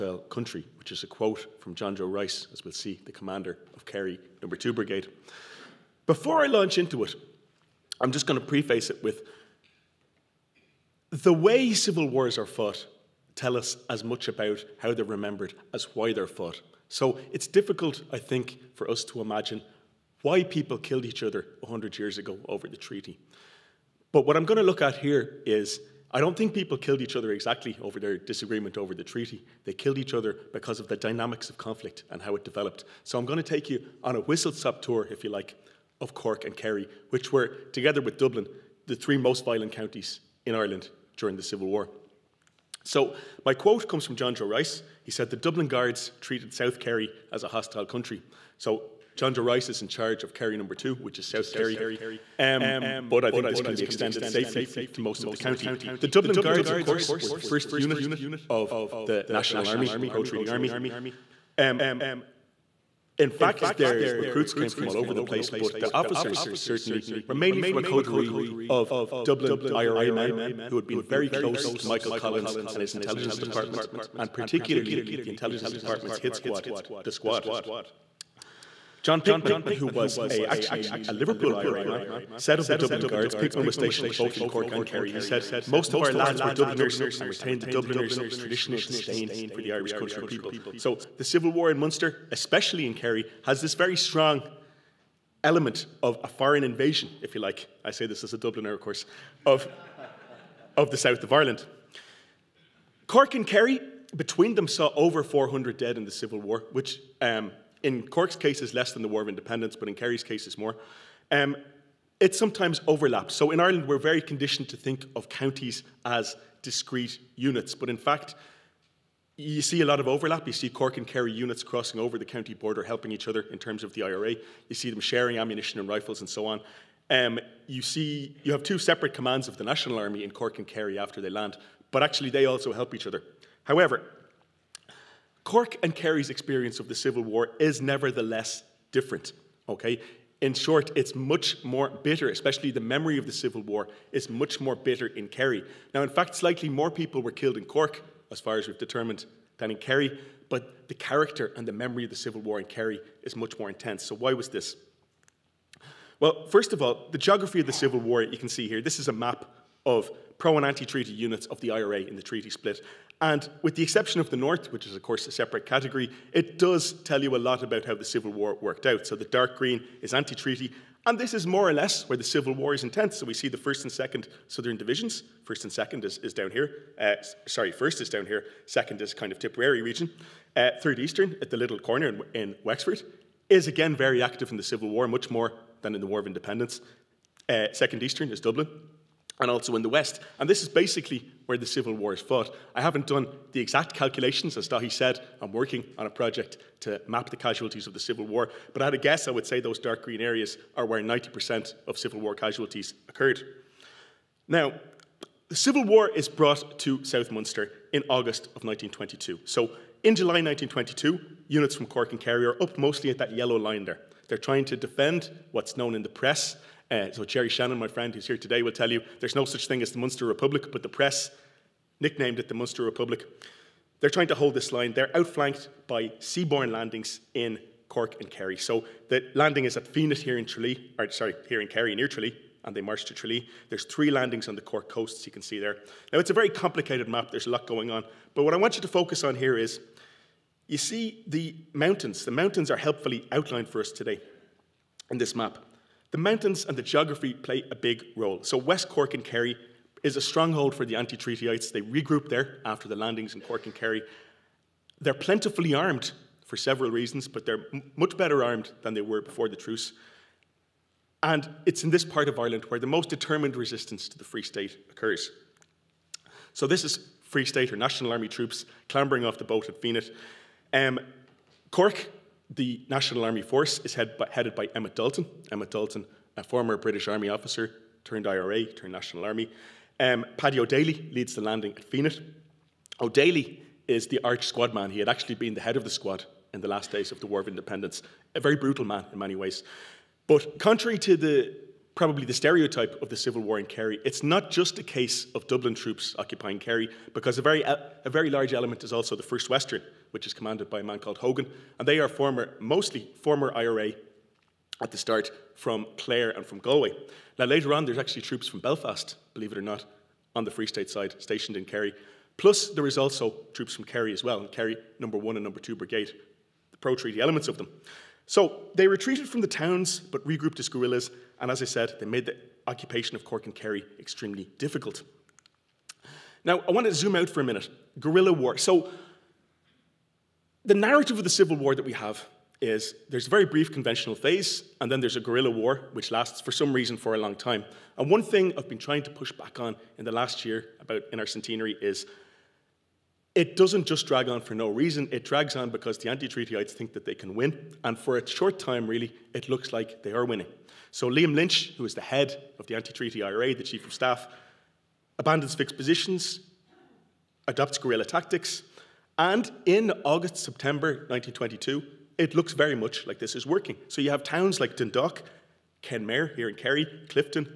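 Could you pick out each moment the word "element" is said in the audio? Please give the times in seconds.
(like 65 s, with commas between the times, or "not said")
95 s, 298 s, 317 s.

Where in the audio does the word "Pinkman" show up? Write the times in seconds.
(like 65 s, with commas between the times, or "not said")
79 s, 83 s.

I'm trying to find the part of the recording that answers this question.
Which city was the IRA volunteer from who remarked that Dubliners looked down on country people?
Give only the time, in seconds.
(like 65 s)
81 s.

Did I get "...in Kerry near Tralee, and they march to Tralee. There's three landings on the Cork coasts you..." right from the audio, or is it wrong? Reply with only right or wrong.
right.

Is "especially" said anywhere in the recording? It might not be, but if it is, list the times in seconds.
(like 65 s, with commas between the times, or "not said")
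92 s, 142 s.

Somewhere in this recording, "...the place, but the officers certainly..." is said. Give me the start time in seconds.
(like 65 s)
65 s.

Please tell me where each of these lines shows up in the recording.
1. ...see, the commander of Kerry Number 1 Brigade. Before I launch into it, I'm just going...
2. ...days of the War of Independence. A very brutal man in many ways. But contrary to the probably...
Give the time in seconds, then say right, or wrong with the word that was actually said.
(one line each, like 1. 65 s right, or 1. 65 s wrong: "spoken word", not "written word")
1. 2 s wrong: "2", not "1"
2. 286 s right.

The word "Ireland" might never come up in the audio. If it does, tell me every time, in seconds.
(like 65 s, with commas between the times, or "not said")
40 s, 101 s, 113 s, 262 s.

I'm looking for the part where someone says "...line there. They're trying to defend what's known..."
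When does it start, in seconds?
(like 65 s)
213 s.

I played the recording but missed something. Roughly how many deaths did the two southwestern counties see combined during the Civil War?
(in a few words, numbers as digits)
over 400.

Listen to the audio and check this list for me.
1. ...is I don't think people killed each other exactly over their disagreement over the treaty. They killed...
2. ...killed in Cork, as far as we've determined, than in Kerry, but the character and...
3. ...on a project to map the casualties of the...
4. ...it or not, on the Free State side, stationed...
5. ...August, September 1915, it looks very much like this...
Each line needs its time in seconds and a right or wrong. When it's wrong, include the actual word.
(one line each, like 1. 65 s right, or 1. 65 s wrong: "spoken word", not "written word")
1. 25 s right
2. 147 s right
3. 195 s right
4. 309 s right
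5. 360 s wrong: "1922", not "1915".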